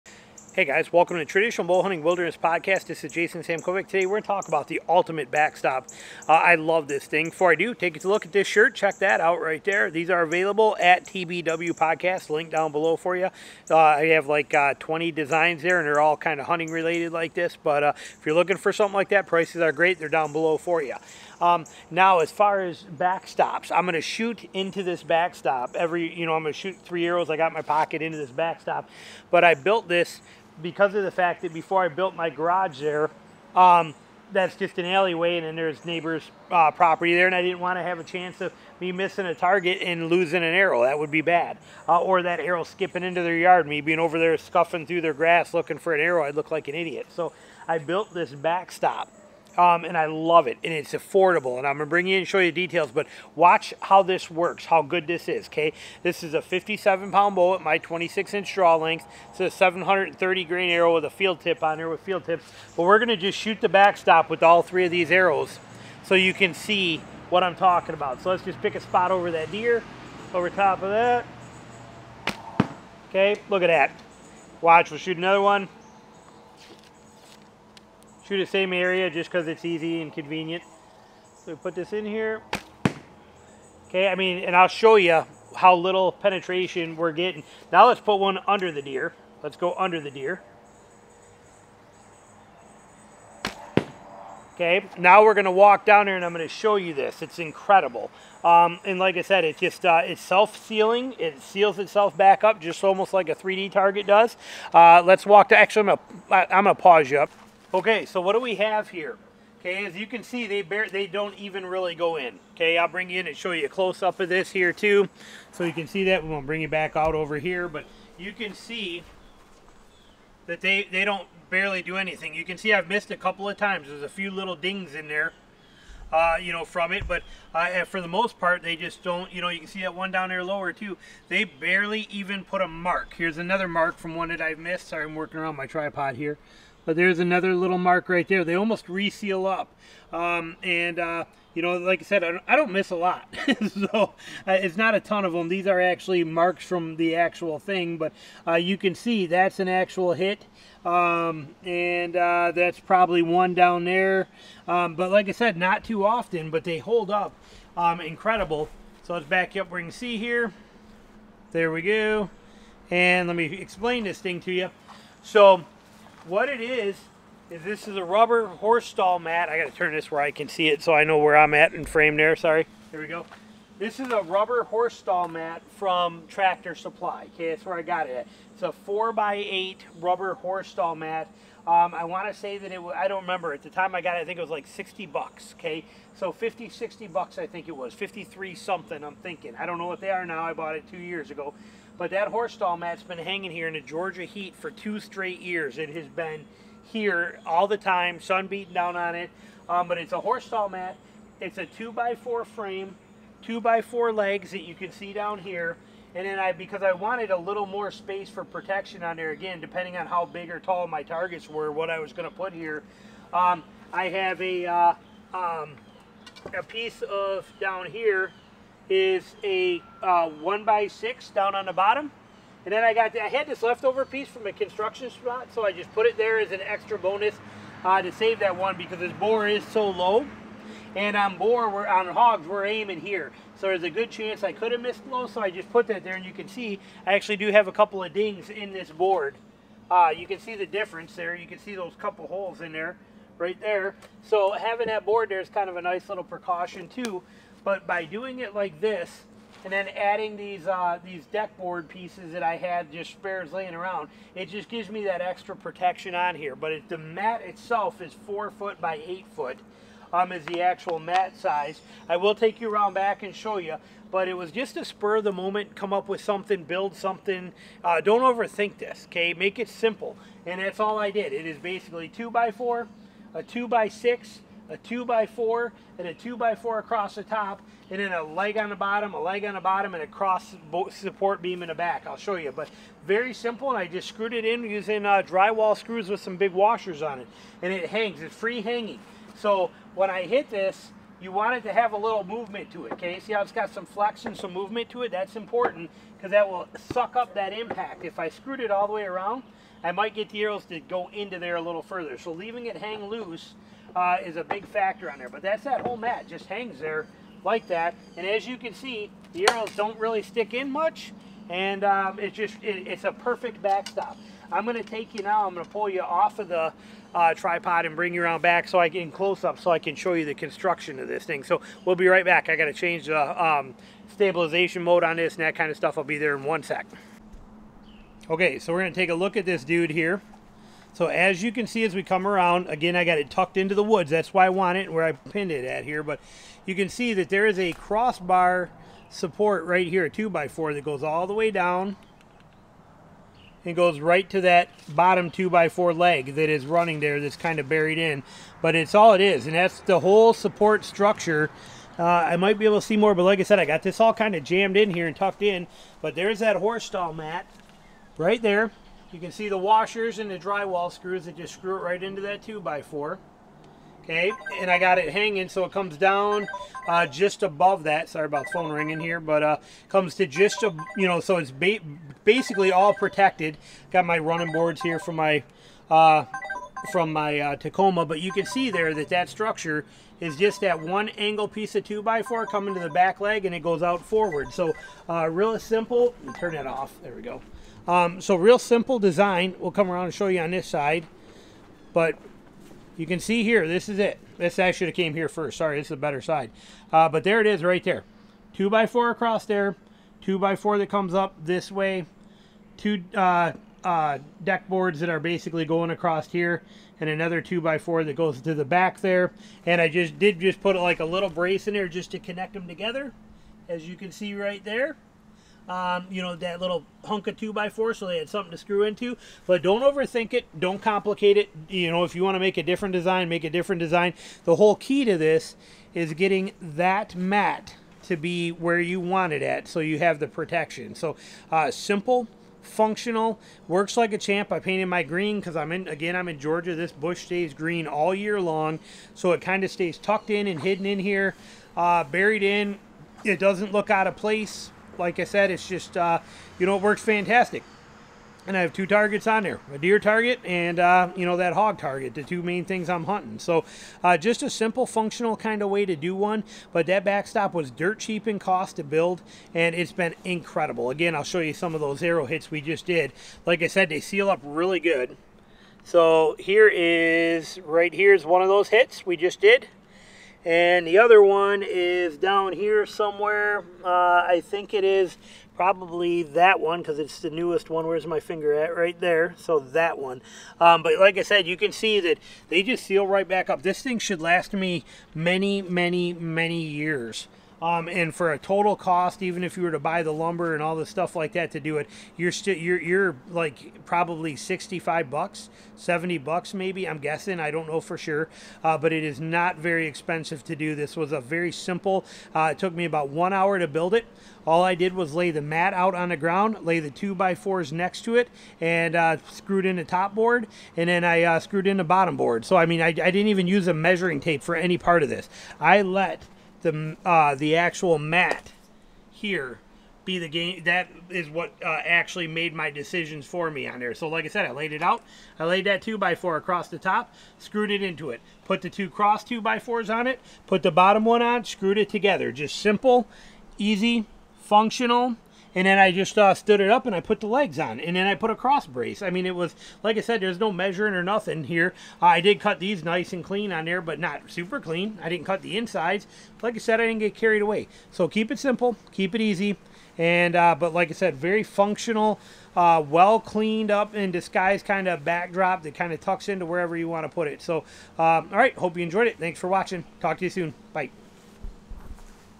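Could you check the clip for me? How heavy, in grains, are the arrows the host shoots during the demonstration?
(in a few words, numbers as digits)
730 grain.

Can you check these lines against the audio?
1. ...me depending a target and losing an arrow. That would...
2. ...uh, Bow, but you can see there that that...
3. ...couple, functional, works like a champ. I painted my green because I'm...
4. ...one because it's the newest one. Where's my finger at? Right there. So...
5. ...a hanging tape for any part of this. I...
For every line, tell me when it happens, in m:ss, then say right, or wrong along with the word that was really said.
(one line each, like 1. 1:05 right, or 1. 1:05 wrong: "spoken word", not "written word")
1. 0:38 wrong: "missing", not "depending"
2. 6:17 wrong: "Tacoma", not "Bow"
3. 7:11 wrong: "simple", not "couple"
4. 7:56 right
5. 8:33 wrong: "measuring", not "hanging".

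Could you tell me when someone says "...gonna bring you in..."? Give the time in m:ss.
0:51.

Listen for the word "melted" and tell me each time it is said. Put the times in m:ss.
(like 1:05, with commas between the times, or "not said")
not said.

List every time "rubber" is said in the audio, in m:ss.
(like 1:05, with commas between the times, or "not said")
2:48, 2:54, 2:59.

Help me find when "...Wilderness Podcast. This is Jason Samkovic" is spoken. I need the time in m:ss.
0:02.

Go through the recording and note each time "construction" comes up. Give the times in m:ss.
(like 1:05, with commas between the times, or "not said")
3:44, 5:20.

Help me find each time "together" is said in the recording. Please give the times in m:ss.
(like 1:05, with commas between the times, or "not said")
6:52, 8:51.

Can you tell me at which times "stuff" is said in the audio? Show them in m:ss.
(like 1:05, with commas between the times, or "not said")
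5:25, 8:10.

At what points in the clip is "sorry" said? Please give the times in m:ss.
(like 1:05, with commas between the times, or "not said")
2:14, 2:52, 6:08, 6:35.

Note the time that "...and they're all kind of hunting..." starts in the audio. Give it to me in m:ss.
0:15.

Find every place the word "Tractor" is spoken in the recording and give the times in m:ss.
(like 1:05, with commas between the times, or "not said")
2:56.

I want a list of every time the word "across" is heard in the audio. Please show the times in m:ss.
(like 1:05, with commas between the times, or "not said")
4:36, 6:39, 6:45, 8:46.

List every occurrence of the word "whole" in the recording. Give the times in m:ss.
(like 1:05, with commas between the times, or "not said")
5:05, 5:49, 7:04.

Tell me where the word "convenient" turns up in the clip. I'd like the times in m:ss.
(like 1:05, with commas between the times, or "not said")
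1:20.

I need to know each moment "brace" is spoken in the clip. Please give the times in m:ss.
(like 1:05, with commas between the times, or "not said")
6:51, 8:58.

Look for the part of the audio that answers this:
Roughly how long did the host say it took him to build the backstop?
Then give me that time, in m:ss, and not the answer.
8:23.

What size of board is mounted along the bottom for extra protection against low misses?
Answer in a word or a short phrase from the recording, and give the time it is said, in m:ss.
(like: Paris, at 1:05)
1 by 6, at 3:40.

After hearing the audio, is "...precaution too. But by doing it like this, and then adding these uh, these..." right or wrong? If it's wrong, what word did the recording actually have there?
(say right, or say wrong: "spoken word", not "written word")
right.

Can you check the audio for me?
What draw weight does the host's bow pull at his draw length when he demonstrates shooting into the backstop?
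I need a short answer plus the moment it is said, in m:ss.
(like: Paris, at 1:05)
57 pounds, at 0:56.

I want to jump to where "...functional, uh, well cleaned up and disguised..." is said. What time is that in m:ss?
9:11.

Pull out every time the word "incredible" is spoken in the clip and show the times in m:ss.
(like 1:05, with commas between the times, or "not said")
1:37, 2:38, 7:40.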